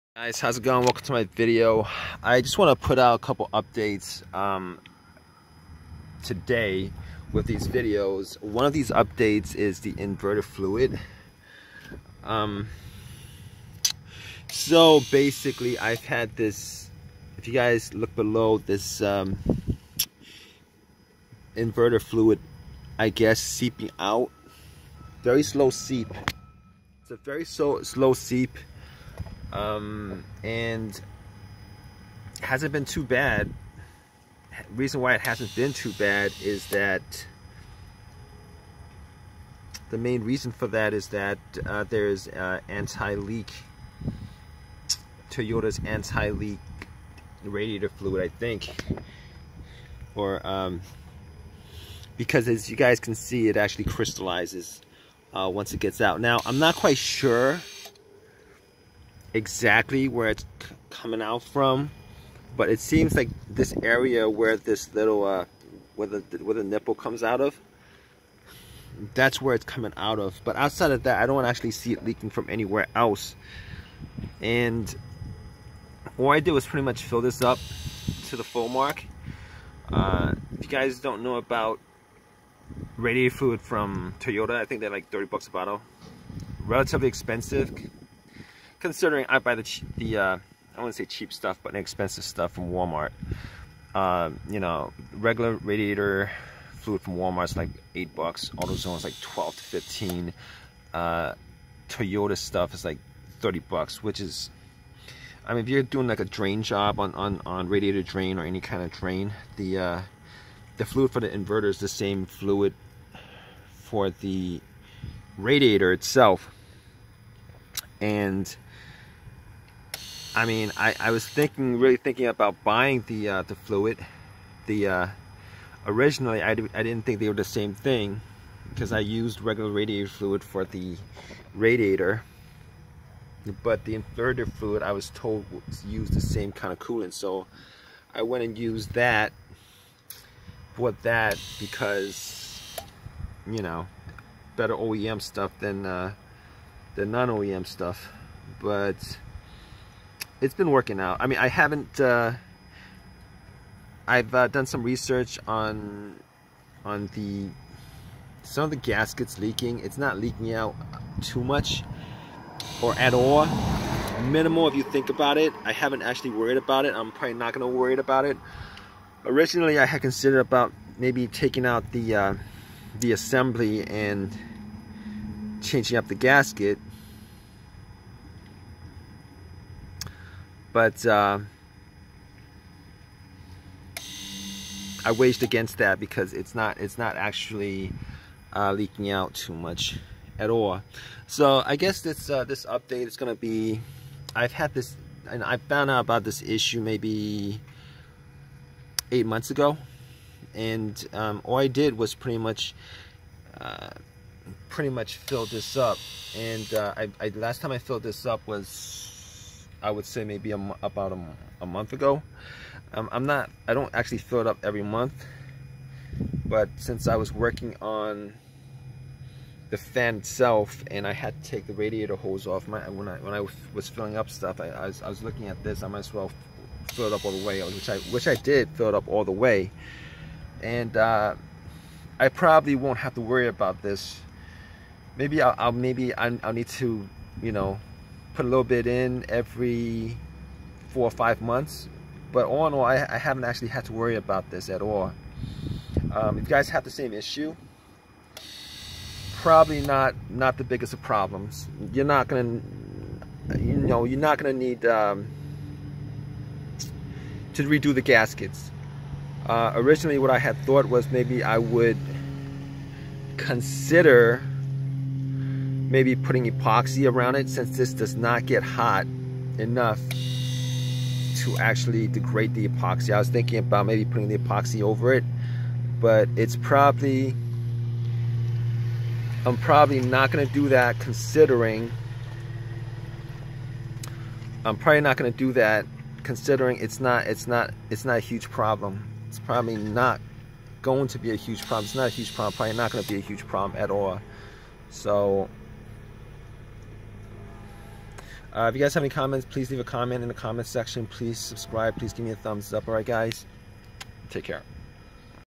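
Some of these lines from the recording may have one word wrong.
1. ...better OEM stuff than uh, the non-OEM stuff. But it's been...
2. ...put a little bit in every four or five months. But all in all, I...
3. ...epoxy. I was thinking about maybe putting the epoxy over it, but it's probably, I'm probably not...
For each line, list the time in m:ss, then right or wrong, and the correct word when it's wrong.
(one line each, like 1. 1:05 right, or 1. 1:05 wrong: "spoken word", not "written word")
1. 2:24 right
2. 3:58 right
3. 4:32 right.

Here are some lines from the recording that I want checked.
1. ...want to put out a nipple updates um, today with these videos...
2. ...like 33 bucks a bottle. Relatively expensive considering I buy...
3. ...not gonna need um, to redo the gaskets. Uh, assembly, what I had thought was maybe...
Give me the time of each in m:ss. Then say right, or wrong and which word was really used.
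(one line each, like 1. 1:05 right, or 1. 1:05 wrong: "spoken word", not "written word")
1. 0:02 wrong: "couple", not "nipple"
2. 1:24 wrong: "30", not "33"
3. 4:14 wrong: "originally", not "assembly".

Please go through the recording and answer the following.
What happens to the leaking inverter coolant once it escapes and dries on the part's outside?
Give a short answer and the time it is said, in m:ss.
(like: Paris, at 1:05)
crystallizes, at 0:53.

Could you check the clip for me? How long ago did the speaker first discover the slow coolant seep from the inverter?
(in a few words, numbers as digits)
8 months.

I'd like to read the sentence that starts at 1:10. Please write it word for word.
But outside of that, I don't actually see it leaking from anywhere else.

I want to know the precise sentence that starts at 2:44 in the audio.
Minimal if you think about it.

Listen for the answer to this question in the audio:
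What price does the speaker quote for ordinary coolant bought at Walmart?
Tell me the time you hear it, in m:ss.
1:37.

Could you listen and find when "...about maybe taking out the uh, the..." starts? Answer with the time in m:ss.
2:50.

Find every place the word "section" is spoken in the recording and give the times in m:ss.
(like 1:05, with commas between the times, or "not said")
5:00.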